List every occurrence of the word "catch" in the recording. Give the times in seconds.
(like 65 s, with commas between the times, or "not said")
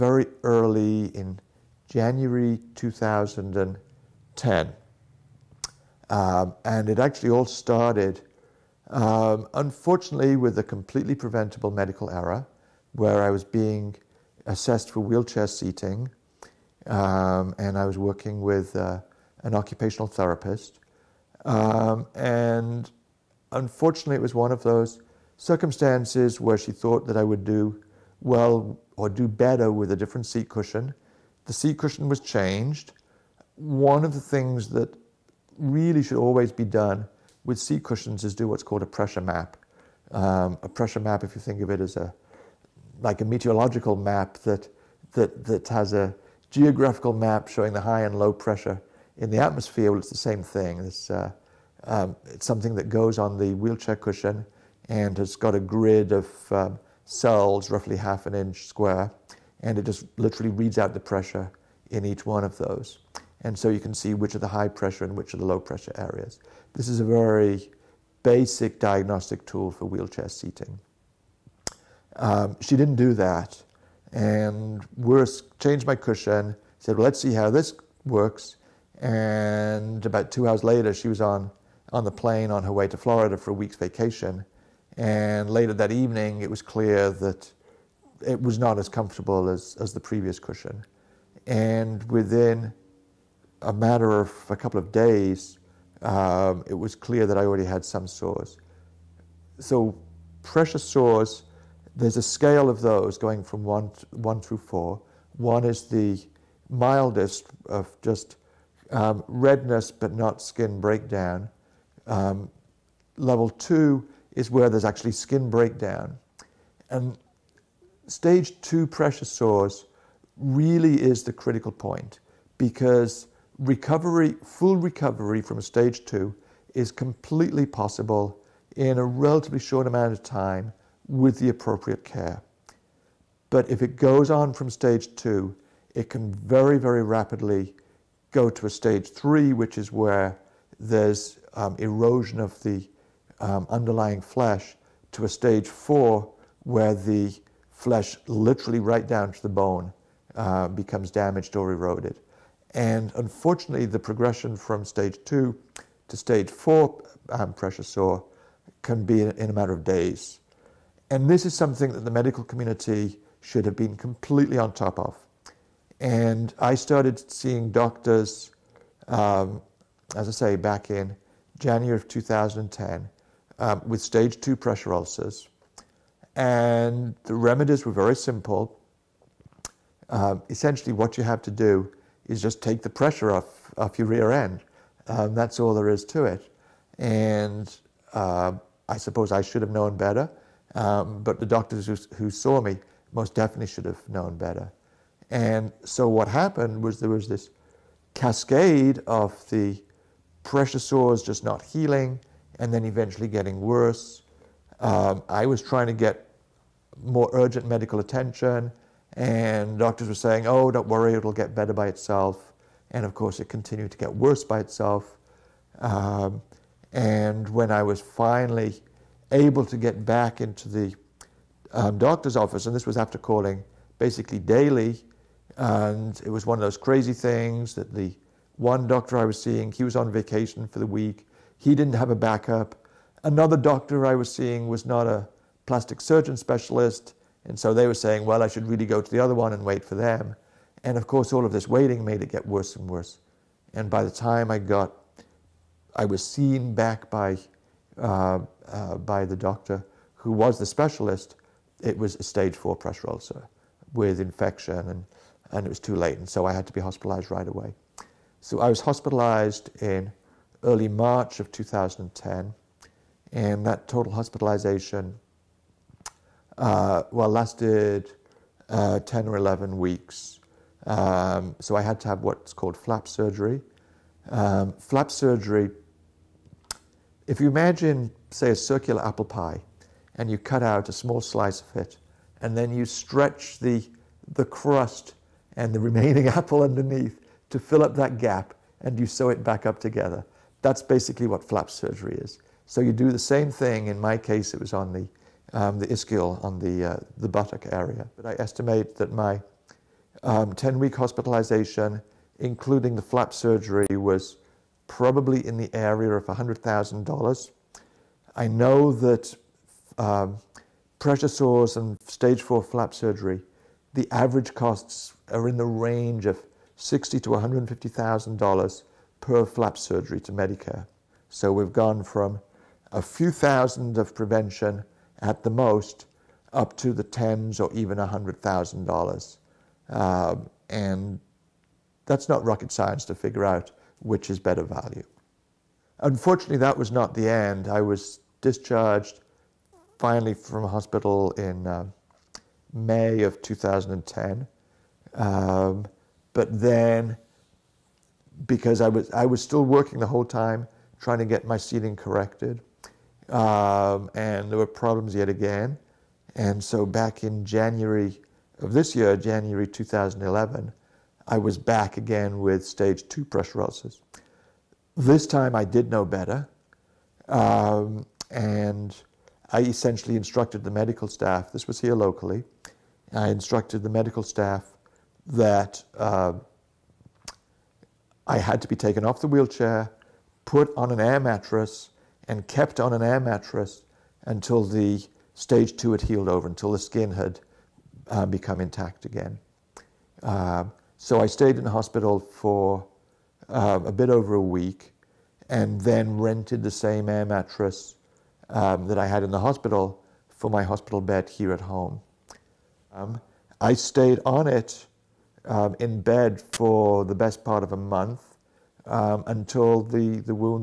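not said.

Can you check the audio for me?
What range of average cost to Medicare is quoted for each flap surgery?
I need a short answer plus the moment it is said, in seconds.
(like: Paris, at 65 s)
$60,000 to $150,000, at 316 s.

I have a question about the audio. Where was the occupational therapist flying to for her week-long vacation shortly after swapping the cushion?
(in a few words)
Florida.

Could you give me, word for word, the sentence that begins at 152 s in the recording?
And unfortunately, the progression from stage two to stage four um, pressure sore can be in a matter of days.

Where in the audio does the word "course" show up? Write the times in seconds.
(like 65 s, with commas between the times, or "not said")
213 s, 241 s.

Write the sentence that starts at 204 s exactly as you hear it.
Um, I was trying to get more urgent medical attention.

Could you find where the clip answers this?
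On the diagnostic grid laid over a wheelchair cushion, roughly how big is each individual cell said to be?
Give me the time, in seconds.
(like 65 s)
57 s.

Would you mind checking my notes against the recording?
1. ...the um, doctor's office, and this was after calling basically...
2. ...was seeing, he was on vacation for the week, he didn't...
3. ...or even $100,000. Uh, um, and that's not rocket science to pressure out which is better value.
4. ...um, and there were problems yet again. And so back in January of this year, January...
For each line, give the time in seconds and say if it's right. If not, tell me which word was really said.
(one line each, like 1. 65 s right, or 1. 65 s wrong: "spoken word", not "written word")
1. 220 s right
2. 229 s right
3. 327 s wrong: "figure", not "pressure"
4. 353 s right.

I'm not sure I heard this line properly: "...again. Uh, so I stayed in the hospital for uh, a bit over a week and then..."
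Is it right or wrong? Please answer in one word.
right.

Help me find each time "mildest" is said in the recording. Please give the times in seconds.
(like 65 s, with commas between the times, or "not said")
106 s.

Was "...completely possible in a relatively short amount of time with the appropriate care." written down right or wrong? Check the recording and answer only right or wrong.
right.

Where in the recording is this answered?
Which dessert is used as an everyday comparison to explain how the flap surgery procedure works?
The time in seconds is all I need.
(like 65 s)
279 s.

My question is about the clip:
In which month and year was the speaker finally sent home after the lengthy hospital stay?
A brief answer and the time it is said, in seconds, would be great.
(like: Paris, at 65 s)
May 2010, at 342 s.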